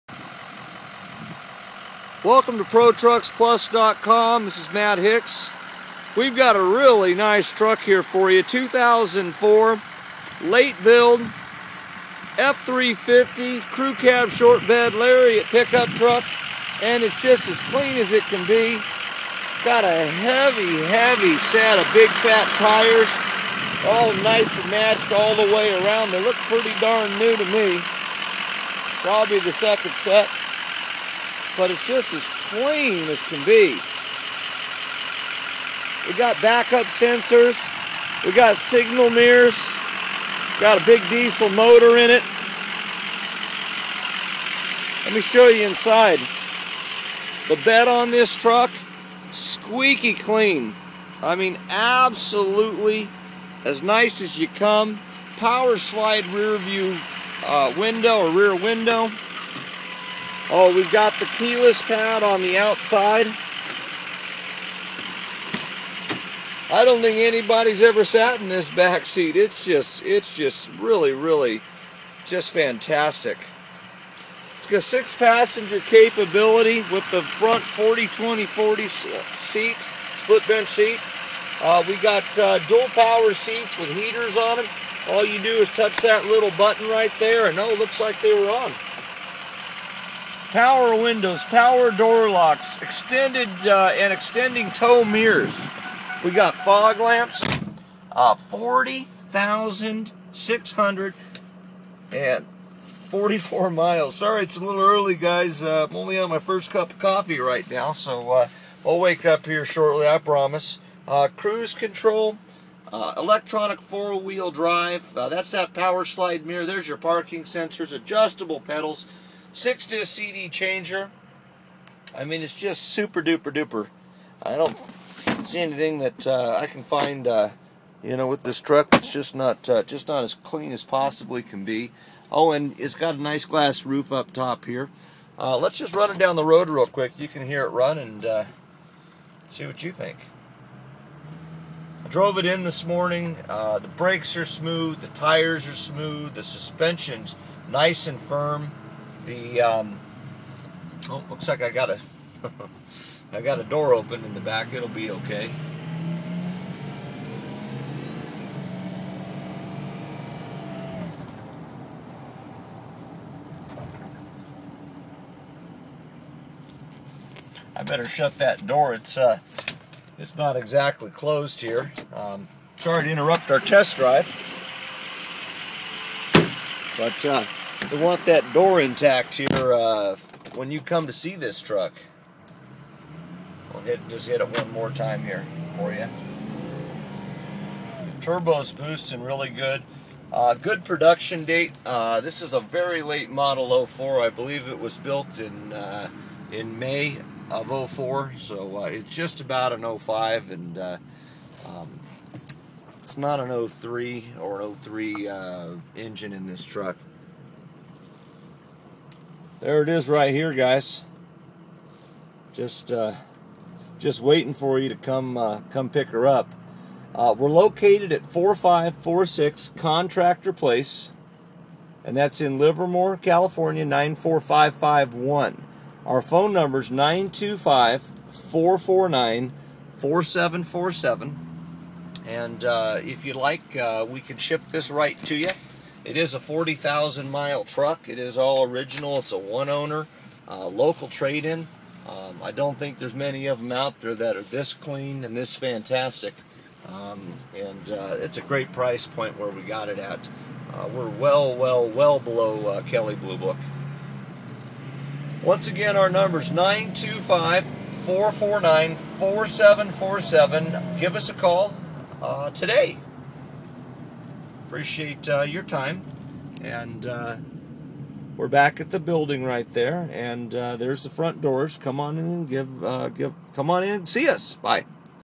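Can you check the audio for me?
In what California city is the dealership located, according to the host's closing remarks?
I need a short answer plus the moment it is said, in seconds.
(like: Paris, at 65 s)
Livermore, at 222 s.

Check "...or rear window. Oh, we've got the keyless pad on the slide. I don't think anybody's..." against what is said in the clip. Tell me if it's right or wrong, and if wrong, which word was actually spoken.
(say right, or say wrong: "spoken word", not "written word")
wrong: "outside", not "slide".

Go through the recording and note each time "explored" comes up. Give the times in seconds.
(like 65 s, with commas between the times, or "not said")
not said.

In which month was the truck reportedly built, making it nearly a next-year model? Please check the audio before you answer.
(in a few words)
May.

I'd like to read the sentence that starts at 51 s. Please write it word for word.
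I mean, absolutely as nice as you come.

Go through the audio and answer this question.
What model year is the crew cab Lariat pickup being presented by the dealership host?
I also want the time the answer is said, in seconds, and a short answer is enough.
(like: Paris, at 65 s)
2004, at 8 s.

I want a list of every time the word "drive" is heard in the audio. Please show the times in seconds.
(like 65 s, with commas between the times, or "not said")
114 s, 173 s.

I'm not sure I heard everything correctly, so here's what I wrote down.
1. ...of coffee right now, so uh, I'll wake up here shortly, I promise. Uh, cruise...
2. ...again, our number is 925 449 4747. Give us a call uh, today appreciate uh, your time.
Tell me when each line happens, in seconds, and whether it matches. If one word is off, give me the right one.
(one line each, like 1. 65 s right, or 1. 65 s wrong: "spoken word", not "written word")
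1. 106 s right
2. 255 s right.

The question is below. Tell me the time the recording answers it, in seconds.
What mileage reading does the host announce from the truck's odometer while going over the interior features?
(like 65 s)
98 s.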